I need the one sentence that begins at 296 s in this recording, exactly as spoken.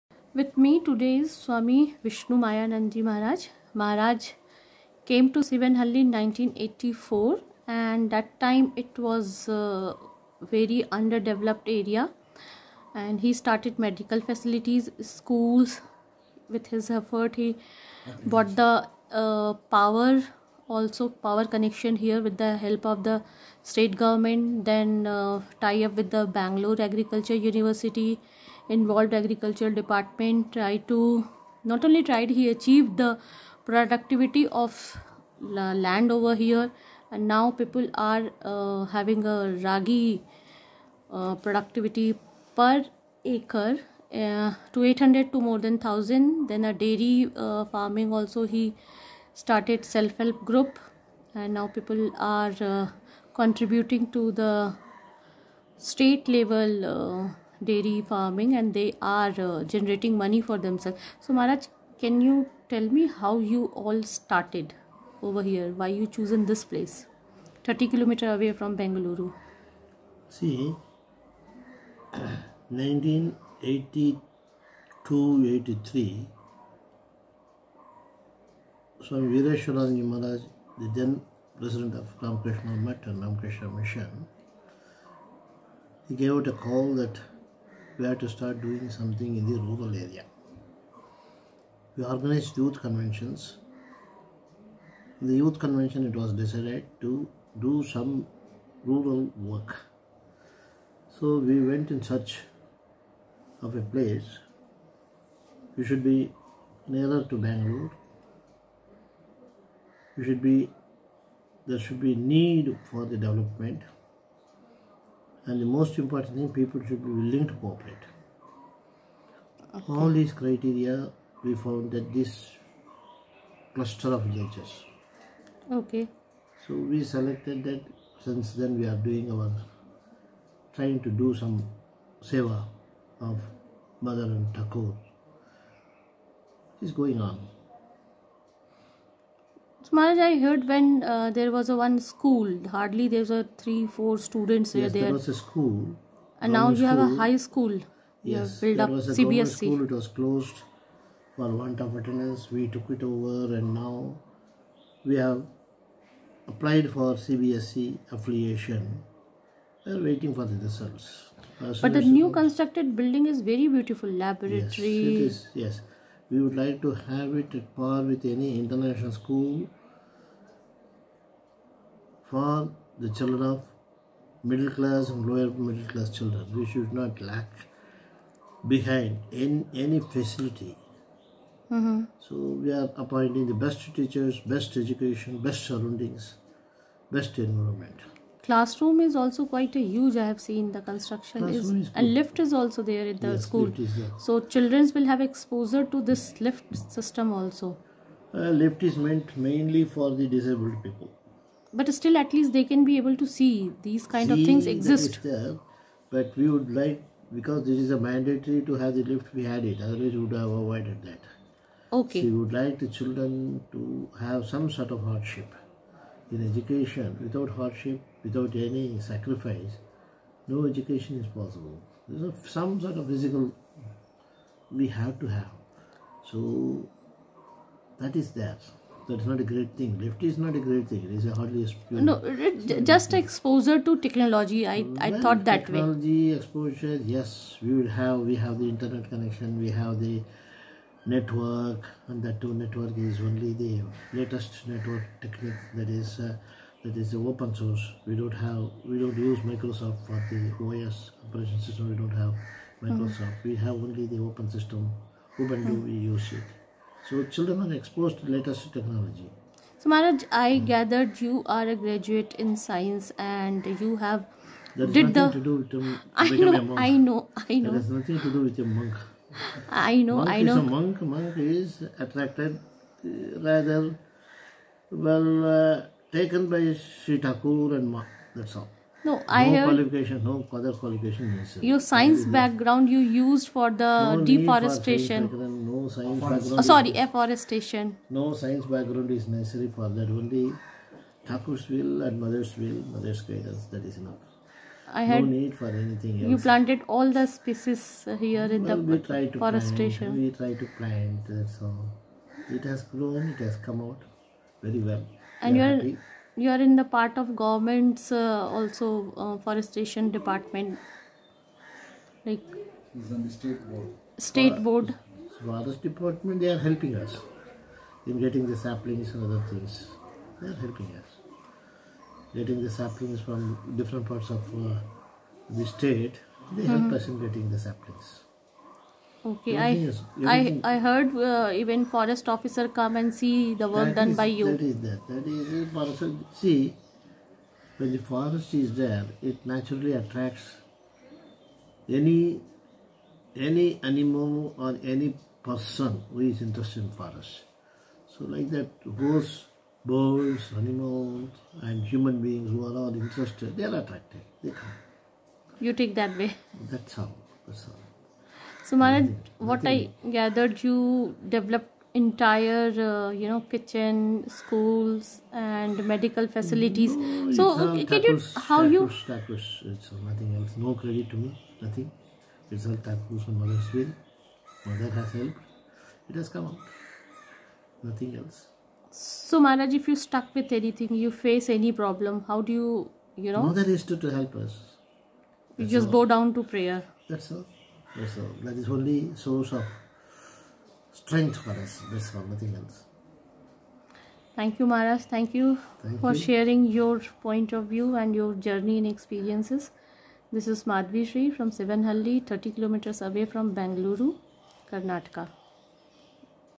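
You planted all the species here in the we try to forestation.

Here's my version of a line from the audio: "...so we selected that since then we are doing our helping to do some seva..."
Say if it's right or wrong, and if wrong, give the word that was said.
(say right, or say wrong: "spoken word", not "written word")
wrong: "trying", not "helping".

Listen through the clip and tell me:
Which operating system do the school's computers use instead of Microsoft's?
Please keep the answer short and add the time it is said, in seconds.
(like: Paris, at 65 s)
Ubuntu, at 255 s.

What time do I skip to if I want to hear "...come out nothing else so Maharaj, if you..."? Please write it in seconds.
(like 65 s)
376 s.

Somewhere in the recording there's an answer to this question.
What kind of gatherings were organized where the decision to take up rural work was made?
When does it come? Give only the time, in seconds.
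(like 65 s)
92 s.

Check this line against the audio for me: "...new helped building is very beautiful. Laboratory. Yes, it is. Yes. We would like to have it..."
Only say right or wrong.
wrong.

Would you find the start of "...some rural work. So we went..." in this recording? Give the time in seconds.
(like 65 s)
97 s.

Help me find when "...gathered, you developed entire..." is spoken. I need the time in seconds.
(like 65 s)
360 s.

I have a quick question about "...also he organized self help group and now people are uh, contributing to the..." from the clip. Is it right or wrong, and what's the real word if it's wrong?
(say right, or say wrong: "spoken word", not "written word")
wrong: "started", not "organized".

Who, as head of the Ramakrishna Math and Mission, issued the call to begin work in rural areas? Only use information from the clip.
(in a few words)
Swami Vireshwaranji Maharaj.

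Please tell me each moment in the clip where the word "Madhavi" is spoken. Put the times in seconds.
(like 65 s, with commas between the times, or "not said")
400 s.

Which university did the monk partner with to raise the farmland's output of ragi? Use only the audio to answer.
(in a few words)
Bangalore Agriculture University.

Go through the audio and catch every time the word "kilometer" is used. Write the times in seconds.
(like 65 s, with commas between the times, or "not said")
67 s, 402 s.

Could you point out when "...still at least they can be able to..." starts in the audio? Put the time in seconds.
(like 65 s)
201 s.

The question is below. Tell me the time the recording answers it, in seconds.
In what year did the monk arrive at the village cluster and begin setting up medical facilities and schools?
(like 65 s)
6 s.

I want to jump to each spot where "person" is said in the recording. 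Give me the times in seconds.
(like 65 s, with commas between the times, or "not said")
335 s, 345 s.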